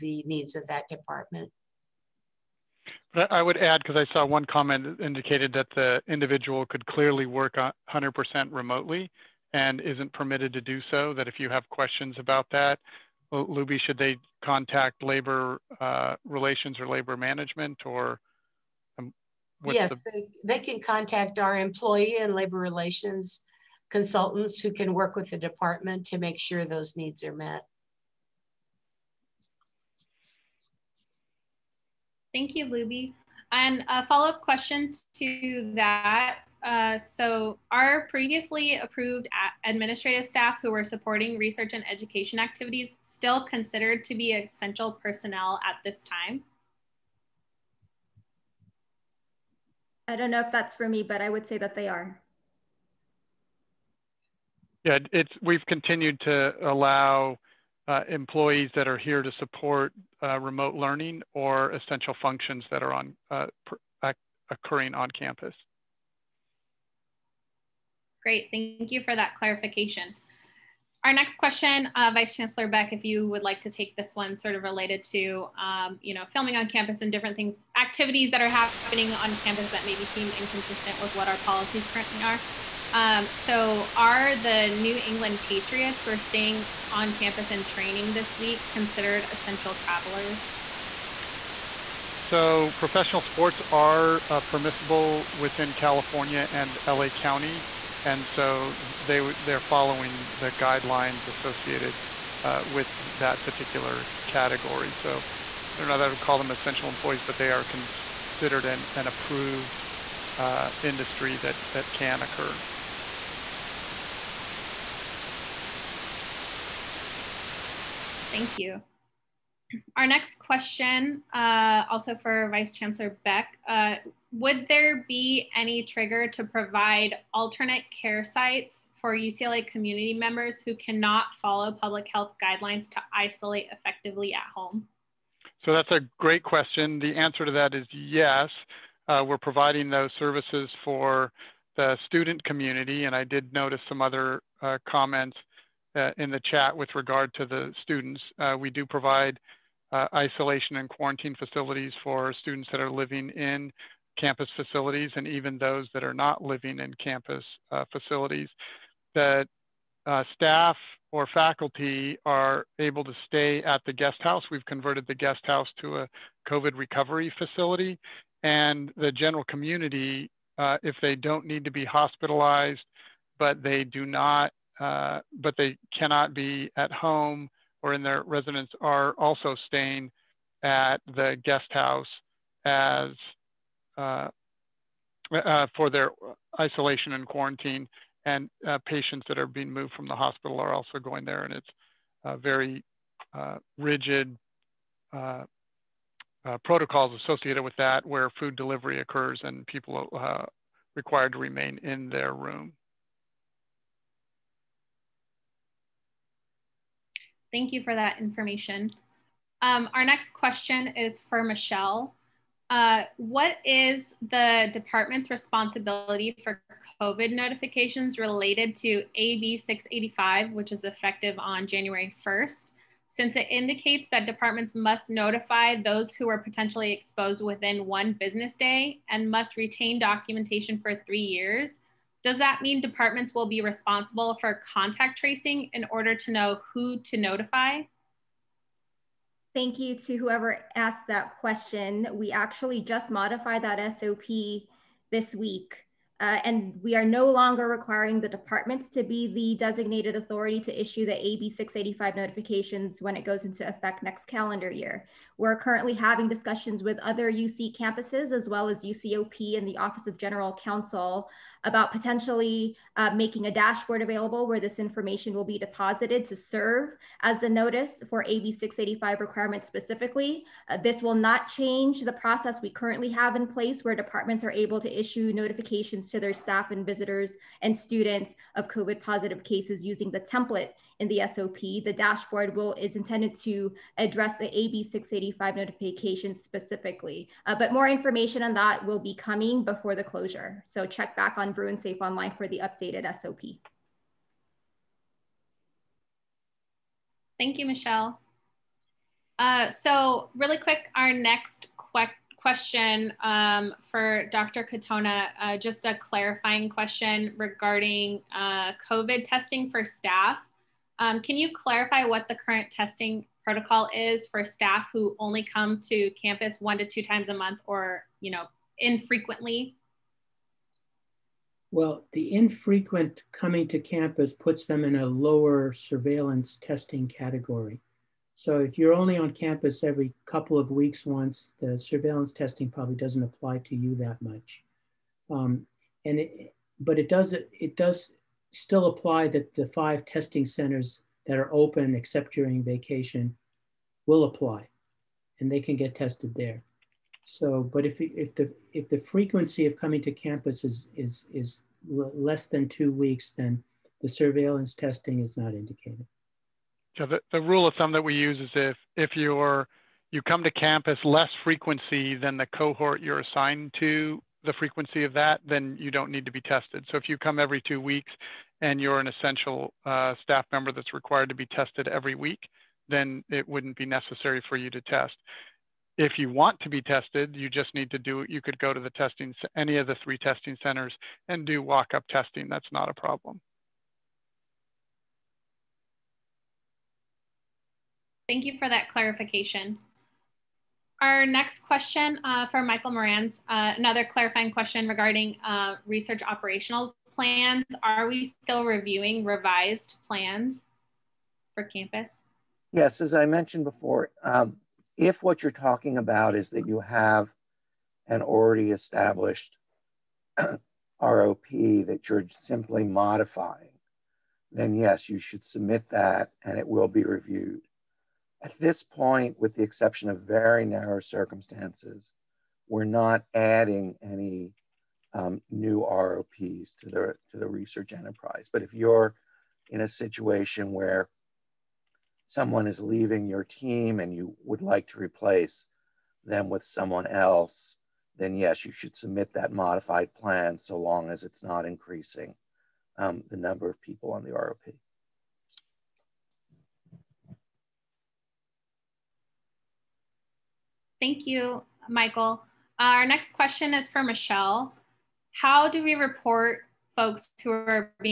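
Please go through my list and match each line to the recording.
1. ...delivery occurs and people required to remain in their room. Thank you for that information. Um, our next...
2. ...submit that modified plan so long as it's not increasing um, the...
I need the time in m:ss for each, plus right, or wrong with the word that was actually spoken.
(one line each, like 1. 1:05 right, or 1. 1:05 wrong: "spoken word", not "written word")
1. 3:18 right
2. 7:18 right.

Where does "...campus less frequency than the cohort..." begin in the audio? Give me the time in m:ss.
6:00.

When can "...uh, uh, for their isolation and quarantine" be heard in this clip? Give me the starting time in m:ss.
3:03.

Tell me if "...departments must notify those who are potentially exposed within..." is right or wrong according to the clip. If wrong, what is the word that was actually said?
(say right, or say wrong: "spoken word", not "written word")
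right.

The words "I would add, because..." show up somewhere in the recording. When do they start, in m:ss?
0:03.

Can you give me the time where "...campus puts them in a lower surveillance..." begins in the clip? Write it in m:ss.
5:23.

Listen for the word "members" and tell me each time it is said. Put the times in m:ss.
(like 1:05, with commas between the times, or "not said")
2:10, 6:10.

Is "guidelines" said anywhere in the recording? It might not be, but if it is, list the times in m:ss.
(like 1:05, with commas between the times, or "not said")
1:40, 2:12.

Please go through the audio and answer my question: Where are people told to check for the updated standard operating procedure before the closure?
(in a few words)
Bruin Safe Online.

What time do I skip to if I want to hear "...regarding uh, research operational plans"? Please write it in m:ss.
6:34.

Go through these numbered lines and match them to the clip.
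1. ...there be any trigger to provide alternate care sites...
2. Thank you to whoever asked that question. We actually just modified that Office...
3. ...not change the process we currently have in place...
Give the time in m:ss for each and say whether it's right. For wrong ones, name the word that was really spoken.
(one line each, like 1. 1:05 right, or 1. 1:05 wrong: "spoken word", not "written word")
1. 2:04 right
2. 3:59 wrong: "SOP", not "Office"
3. 4:31 right.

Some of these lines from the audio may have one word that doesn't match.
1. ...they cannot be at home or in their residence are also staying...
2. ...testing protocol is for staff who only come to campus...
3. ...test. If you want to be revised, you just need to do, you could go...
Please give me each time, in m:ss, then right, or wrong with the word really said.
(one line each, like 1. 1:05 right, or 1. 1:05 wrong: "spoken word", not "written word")
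1. 2:55 right
2. 5:12 right
3. 6:14 wrong: "tested", not "revised".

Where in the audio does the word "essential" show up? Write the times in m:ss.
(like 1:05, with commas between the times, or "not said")
0:44, 1:01, 1:29, 1:46, 6:09.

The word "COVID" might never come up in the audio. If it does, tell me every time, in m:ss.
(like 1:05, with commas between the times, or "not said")
2:46, 3:36, 4:38, 5:08.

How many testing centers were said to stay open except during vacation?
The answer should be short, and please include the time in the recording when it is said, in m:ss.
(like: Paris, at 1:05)
5, at 5:39.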